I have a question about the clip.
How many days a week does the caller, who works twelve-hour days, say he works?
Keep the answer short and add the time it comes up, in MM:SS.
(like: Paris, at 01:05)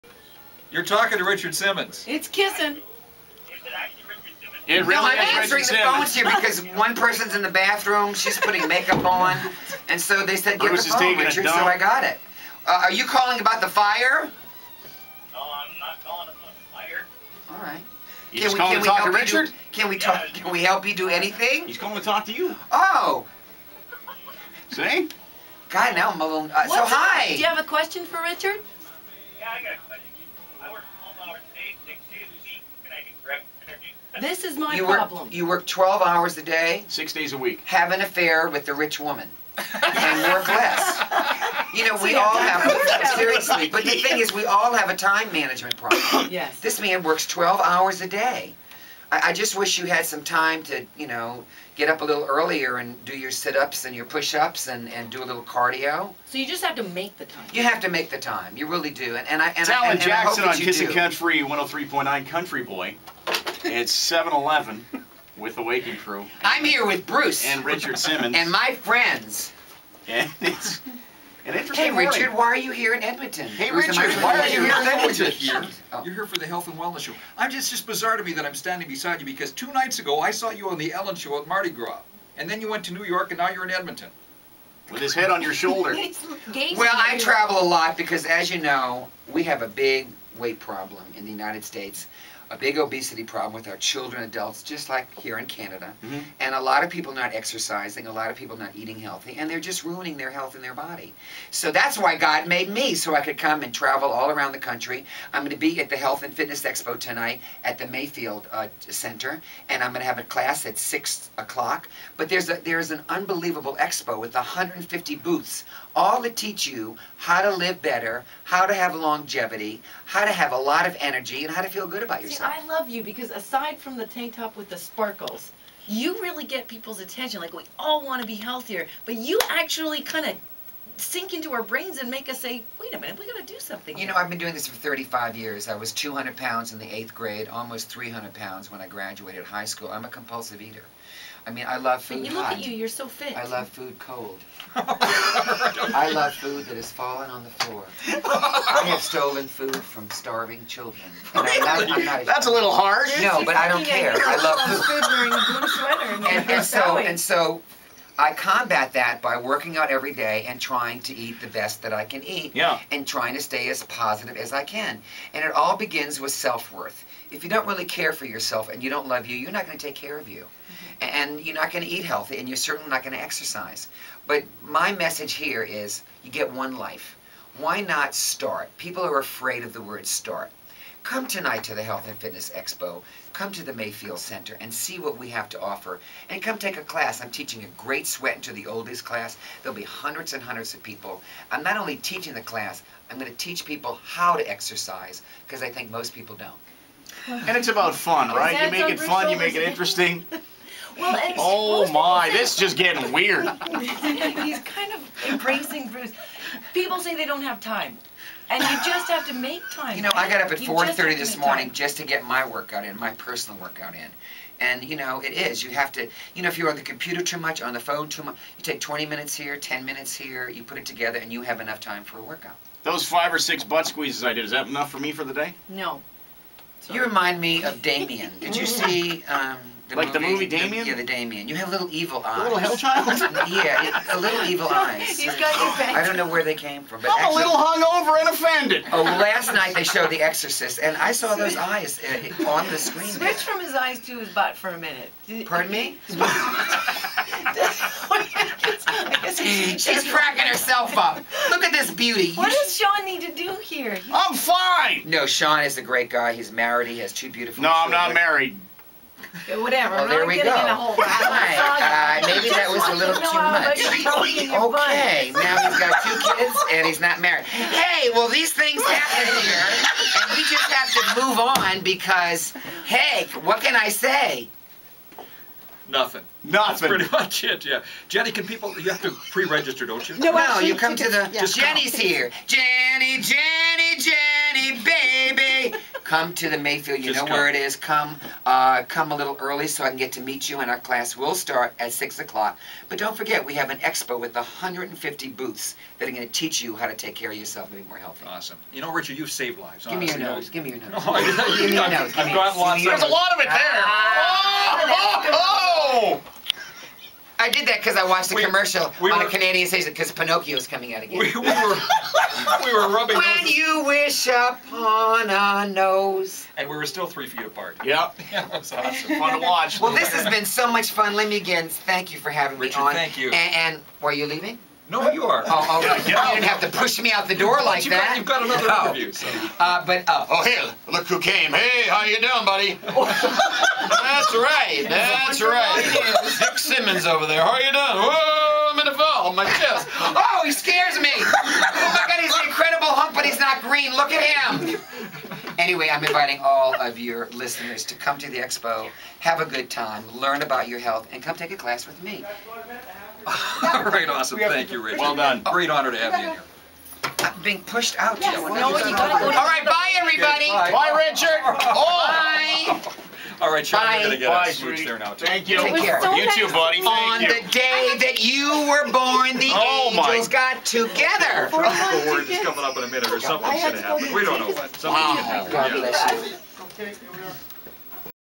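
6, at 00:36.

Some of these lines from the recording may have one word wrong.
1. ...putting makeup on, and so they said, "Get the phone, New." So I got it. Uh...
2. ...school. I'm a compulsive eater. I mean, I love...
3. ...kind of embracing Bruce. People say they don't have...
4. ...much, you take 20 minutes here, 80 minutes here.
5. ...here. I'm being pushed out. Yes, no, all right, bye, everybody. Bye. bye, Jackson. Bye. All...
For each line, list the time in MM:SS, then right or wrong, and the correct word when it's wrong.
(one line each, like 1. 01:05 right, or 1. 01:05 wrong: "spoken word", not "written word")
1. 00:08 wrong: "Richard", not "New"
2. 02:19 right
3. 03:24 right
4. 03:38 wrong: "10", not "80"
5. 05:56 wrong: "Richard", not "Jackson".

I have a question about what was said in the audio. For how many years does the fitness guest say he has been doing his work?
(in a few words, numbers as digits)
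35.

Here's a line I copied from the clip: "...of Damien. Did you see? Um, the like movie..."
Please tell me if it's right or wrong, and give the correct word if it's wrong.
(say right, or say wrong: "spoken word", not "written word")
right.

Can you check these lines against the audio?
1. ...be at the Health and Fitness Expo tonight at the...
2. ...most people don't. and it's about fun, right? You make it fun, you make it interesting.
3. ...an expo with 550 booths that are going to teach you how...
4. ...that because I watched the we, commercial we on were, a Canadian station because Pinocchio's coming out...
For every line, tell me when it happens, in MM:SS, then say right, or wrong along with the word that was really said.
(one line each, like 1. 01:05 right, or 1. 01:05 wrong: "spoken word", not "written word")
1. 01:45 right
2. 03:15 right
3. 04:53 wrong: "150", not "550"
4. 05:07 right.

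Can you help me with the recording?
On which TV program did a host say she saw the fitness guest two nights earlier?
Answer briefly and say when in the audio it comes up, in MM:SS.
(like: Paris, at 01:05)
The Ellen Show, at 01:20.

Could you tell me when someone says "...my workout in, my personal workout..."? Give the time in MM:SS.
03:32.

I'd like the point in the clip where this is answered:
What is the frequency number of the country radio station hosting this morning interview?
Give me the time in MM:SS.
01:01.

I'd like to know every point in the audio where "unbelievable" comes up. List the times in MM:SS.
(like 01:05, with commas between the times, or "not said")
01:53.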